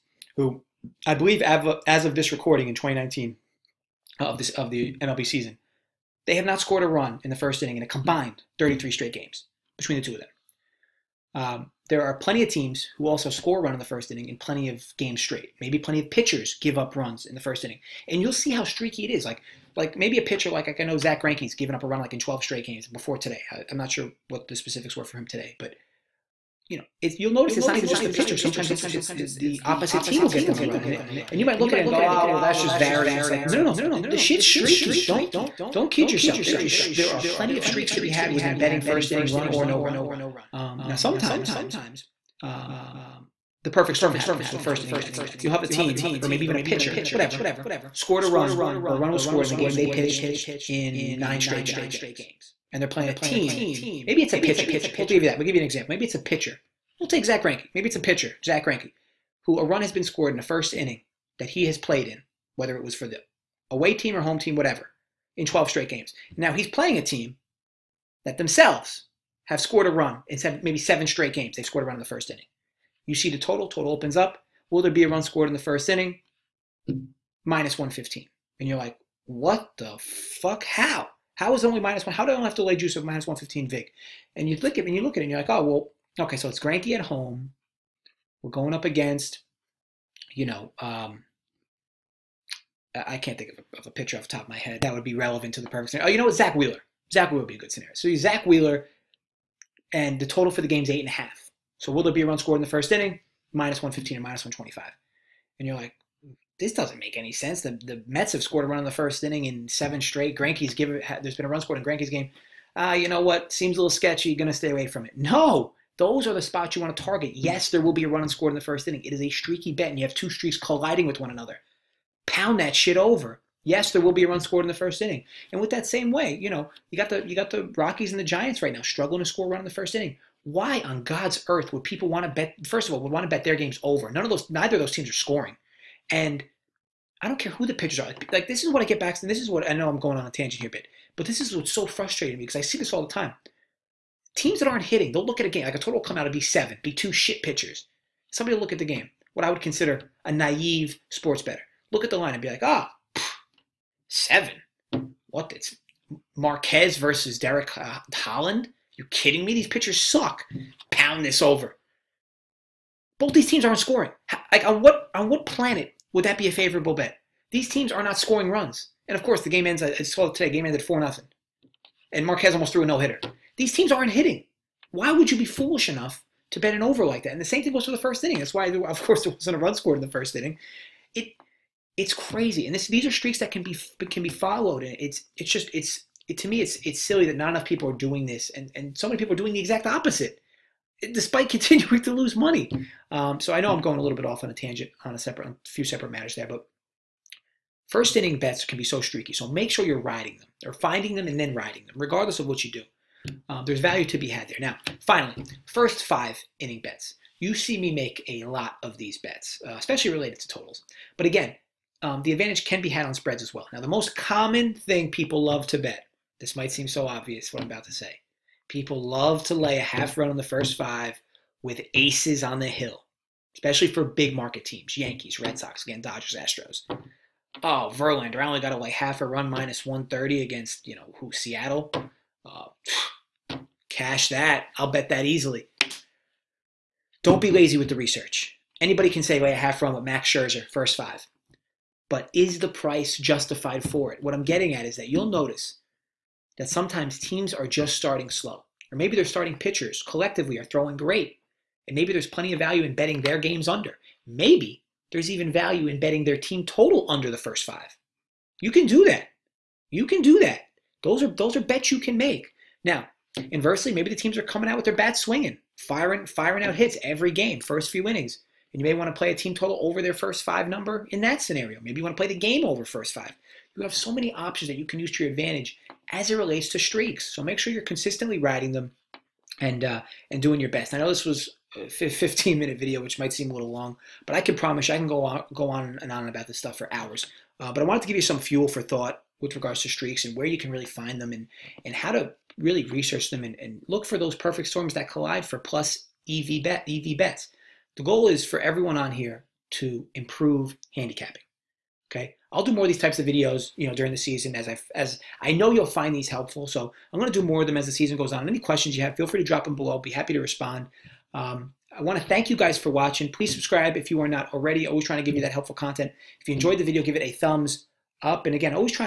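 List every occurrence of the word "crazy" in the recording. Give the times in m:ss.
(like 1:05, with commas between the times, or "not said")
3:02.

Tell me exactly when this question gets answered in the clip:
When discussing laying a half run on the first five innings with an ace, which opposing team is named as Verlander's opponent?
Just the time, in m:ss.
3:51.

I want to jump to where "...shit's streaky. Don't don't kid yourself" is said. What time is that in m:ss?
0:34.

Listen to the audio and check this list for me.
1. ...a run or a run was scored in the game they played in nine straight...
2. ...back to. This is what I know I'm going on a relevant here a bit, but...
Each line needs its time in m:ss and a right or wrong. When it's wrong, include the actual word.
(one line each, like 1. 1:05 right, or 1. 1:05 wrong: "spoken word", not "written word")
1. 0:48 wrong: "pitched", not "played"
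2. 2:18 wrong: "tangent", not "relevant".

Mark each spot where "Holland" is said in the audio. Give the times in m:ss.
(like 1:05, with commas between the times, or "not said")
2:38.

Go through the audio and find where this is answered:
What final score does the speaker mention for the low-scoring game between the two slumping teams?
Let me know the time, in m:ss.
2:50.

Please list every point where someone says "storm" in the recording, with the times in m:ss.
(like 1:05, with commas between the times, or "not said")
0:43, 4:54.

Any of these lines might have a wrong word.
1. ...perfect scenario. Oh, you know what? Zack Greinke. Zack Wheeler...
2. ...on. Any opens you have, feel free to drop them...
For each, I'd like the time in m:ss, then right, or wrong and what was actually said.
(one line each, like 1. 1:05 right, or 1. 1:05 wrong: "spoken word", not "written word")
1. 1:35 wrong: "Wheeler", not "Greinke"
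2. 5:08 wrong: "questions", not "opens".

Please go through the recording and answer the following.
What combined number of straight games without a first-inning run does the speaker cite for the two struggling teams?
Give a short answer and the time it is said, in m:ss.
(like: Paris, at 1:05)
33, at 0:08.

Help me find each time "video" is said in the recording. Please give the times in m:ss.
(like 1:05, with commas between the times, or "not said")
4:42, 5:03, 5:16.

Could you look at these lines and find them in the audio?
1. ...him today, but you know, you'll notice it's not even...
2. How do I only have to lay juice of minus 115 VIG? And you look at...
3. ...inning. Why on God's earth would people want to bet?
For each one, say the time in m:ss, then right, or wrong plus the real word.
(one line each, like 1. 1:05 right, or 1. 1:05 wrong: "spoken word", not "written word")
1. 0:25 right
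2. 1:22 right
3. 2:09 right.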